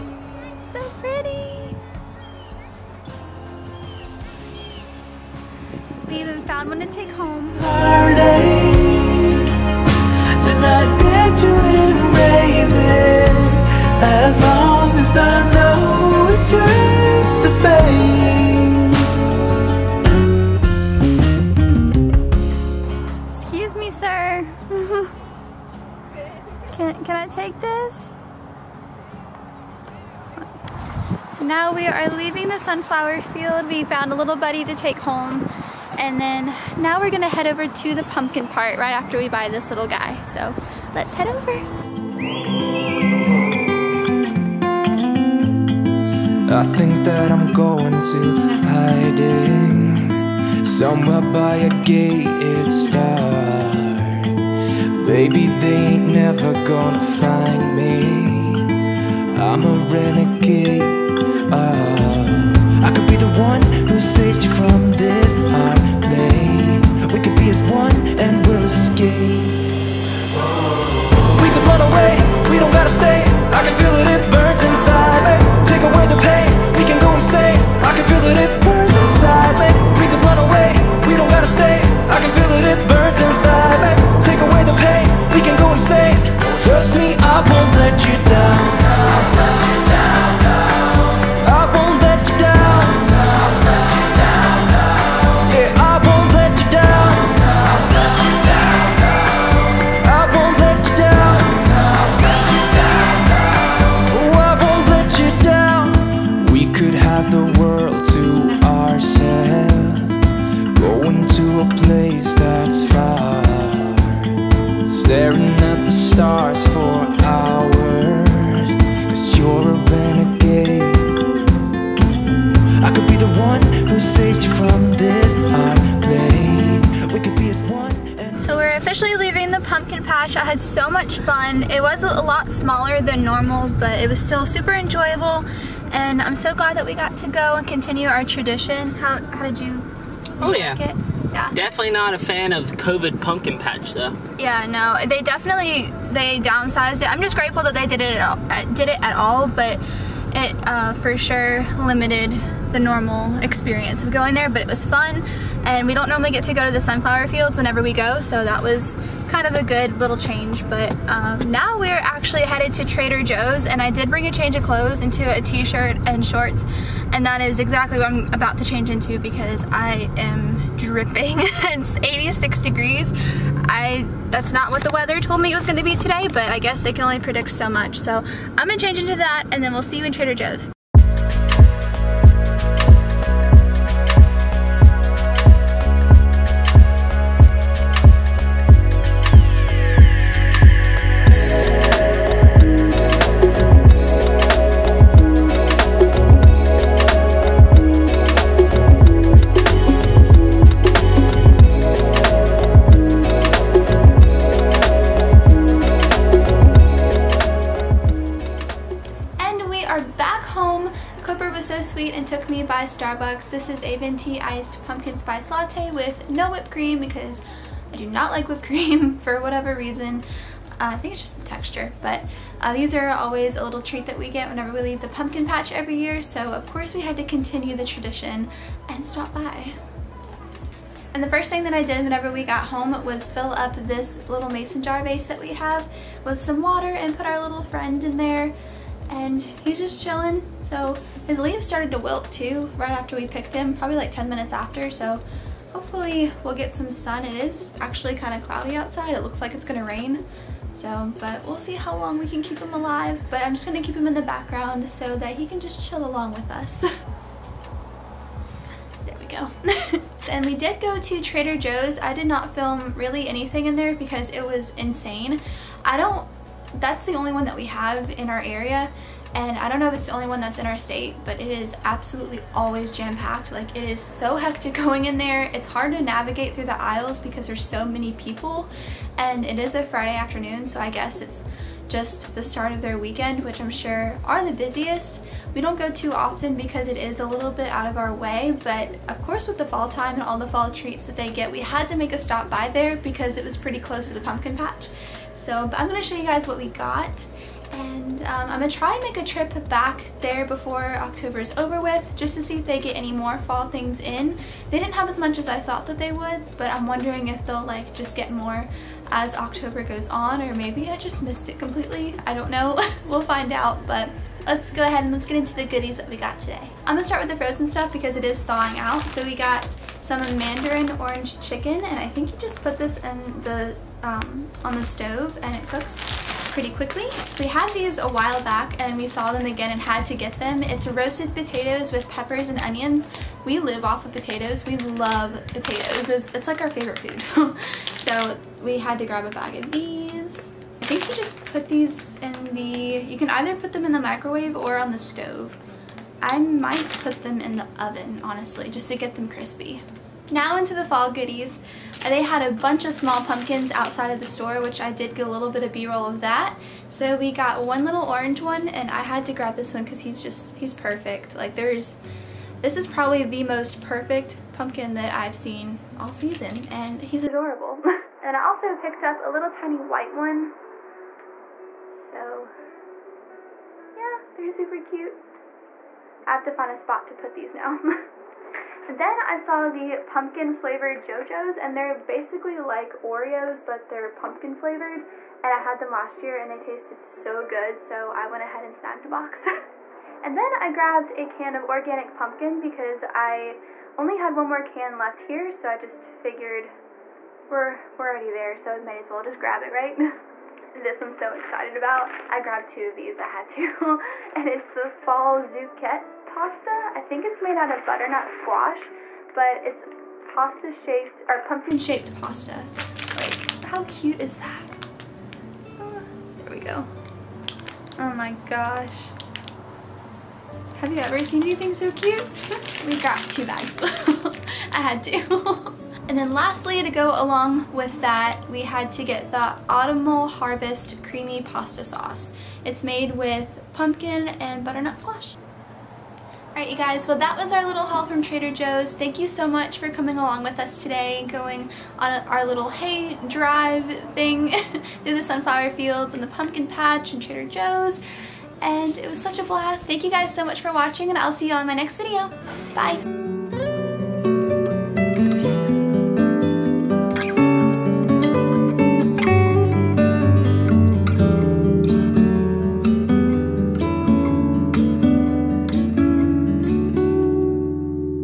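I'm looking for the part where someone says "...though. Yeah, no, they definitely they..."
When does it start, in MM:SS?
02:23.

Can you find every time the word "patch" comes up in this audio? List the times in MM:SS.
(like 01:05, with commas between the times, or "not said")
02:23, 03:45, 04:54, 07:26.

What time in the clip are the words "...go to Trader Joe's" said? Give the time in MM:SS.
04:20.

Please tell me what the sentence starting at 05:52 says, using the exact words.
They had a bunch of small pumpkins outside of the store, which I did get a little bit of b-roll of that.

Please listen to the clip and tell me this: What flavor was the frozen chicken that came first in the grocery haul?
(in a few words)
Mandarin orange.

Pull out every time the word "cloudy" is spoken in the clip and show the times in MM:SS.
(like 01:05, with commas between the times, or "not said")
04:08.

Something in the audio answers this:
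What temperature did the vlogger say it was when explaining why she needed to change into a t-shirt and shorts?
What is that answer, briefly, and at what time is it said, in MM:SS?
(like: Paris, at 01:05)
86 degrees, at 02:51.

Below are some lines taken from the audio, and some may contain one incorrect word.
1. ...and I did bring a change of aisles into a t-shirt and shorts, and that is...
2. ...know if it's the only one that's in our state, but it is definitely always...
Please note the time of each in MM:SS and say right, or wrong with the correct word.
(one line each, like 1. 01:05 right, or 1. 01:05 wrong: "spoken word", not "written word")
1. 02:43 wrong: "clothes", not "aisles"
2. 04:29 wrong: "absolutely", not "definitely".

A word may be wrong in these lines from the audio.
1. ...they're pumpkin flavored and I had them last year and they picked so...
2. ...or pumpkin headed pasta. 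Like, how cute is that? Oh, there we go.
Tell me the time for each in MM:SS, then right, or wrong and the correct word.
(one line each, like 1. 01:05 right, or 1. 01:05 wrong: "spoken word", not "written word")
1. 06:23 wrong: "tasted", not "picked"
2. 06:51 wrong: "shaped", not "headed".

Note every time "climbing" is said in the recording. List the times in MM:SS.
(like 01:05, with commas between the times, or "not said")
not said.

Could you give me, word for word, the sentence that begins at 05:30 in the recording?
It's roasted potatoes with peppers and onions.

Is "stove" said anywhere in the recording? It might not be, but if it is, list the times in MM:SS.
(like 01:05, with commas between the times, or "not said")
05:24, 05:44.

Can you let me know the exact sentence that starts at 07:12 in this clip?
It's made with pumpkin and butternut squash.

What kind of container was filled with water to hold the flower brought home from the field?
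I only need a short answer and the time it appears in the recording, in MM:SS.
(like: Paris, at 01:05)
Mason jar vase, at 03:54.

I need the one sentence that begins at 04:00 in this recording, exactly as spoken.
So his leaves started to wilt too right after we picked him, probably like 10 minutes after.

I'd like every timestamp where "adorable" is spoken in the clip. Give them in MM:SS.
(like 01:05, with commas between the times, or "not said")
06:07.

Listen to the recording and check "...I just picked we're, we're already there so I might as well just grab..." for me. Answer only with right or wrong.
wrong.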